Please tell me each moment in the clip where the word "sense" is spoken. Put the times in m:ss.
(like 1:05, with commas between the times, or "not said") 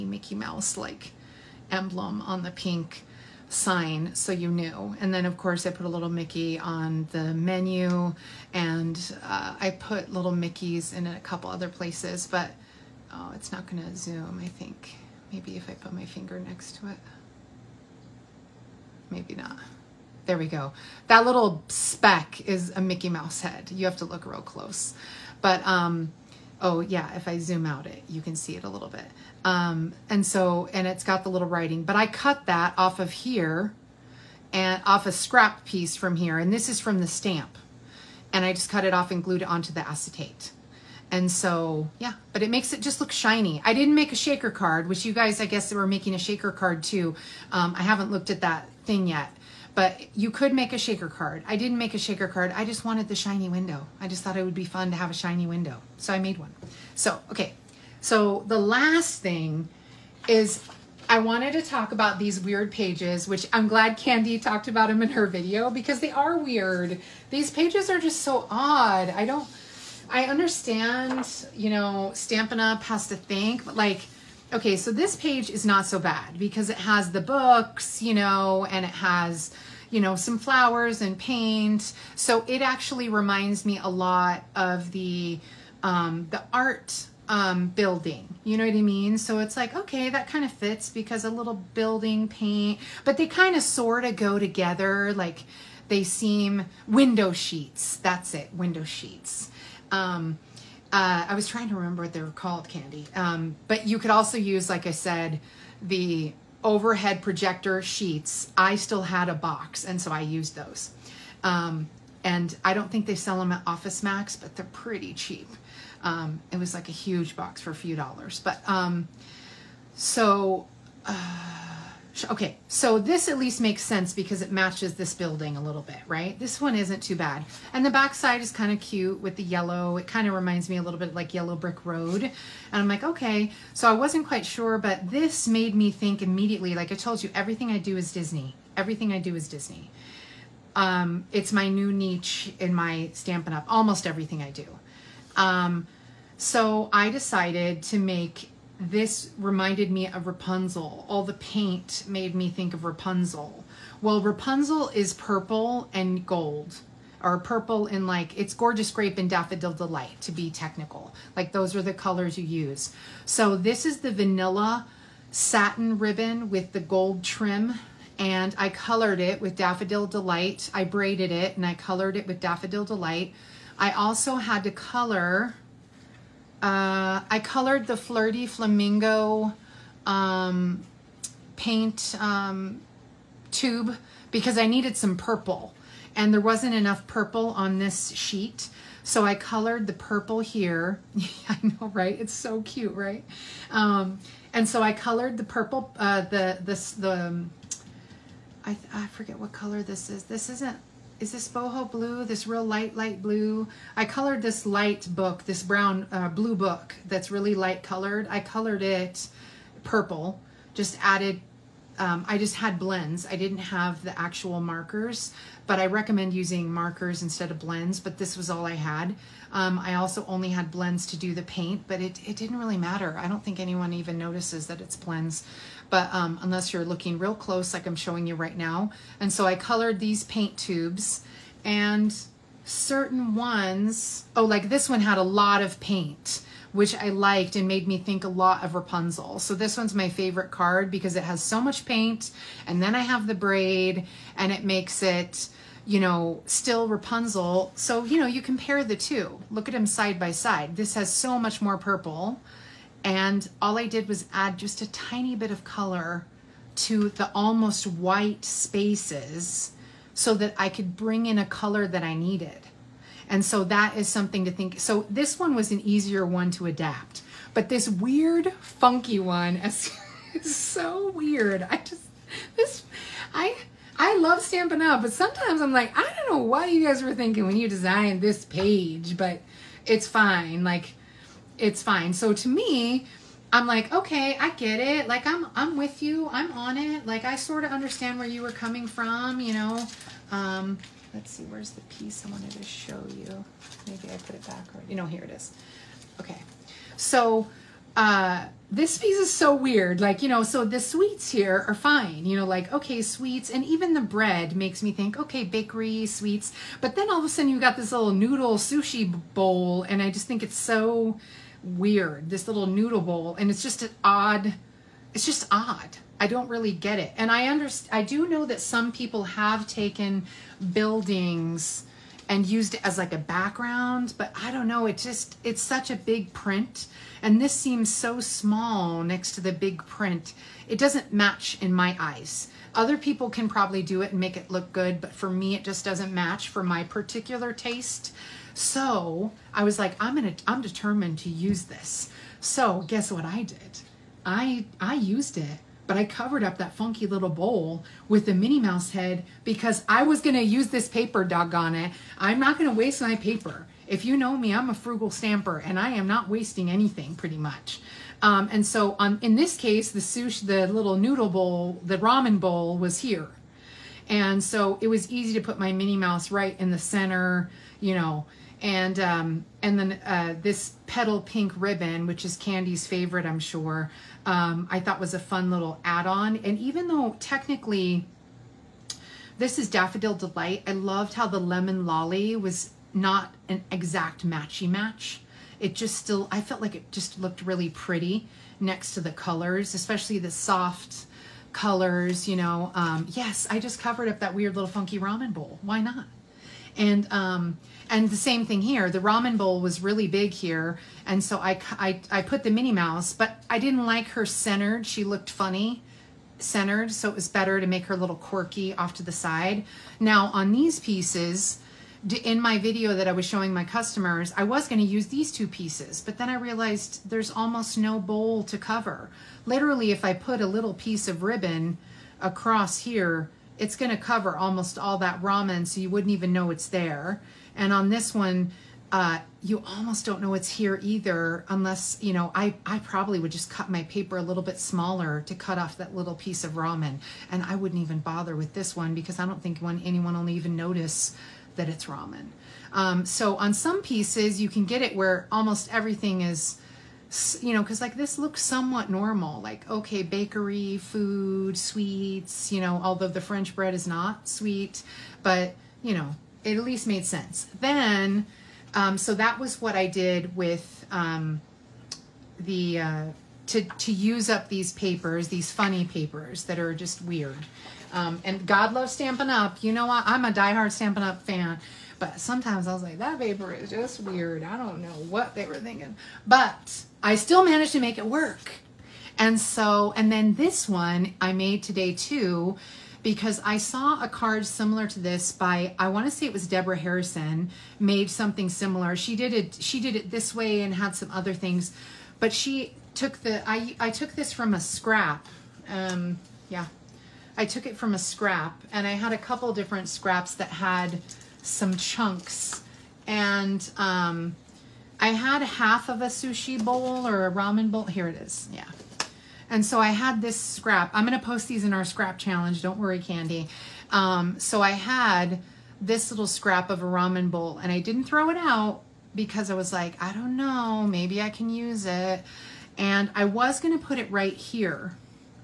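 2:03, 7:37.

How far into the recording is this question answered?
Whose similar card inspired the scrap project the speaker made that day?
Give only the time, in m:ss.
8:06.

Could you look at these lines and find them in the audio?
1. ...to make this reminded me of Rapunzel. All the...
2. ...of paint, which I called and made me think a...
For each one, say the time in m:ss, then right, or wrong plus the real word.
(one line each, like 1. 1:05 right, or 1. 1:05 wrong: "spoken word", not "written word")
1. 2:27 right
2. 3:55 wrong: "liked", not "called".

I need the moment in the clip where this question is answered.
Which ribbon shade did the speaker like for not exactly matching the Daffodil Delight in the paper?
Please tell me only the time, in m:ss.
6:21.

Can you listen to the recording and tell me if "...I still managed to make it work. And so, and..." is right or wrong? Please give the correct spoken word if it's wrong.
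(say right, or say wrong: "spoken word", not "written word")
right.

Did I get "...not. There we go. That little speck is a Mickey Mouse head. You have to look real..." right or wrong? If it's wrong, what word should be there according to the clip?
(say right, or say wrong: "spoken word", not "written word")
right.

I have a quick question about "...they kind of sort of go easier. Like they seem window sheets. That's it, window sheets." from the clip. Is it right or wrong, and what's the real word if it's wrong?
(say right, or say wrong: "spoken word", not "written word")
wrong: "together", not "easier".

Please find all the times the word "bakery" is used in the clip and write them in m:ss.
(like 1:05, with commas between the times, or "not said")
5:05, 7:30.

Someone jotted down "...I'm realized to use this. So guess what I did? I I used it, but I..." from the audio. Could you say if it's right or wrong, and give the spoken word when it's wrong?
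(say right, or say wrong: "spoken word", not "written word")
wrong: "determined", not "realized".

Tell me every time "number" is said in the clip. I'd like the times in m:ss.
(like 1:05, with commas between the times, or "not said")
not said.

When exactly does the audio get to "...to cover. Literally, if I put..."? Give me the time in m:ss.
6:58.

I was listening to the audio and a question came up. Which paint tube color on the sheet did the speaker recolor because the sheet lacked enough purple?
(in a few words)
Flirty Flamingo.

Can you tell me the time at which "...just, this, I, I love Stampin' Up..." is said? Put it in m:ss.
4:31.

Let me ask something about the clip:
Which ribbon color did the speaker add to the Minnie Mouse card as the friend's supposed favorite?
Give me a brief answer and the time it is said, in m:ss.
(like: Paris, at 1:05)
petal pink, at 6:10.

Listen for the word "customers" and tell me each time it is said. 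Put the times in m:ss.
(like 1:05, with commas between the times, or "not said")
6:53.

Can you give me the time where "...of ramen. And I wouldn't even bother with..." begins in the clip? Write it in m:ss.
7:16.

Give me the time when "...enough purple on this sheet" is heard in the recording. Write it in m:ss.
3:06.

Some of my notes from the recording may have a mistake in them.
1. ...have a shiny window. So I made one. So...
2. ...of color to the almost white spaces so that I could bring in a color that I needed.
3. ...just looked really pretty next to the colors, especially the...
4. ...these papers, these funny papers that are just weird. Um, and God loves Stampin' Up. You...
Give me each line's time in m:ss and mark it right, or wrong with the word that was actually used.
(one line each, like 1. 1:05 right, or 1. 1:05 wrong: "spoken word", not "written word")
1. 0:54 right
2. 4:15 right
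3. 6:26 right
4. 7:44 right.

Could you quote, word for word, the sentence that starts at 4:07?
So, you know, you compare the two.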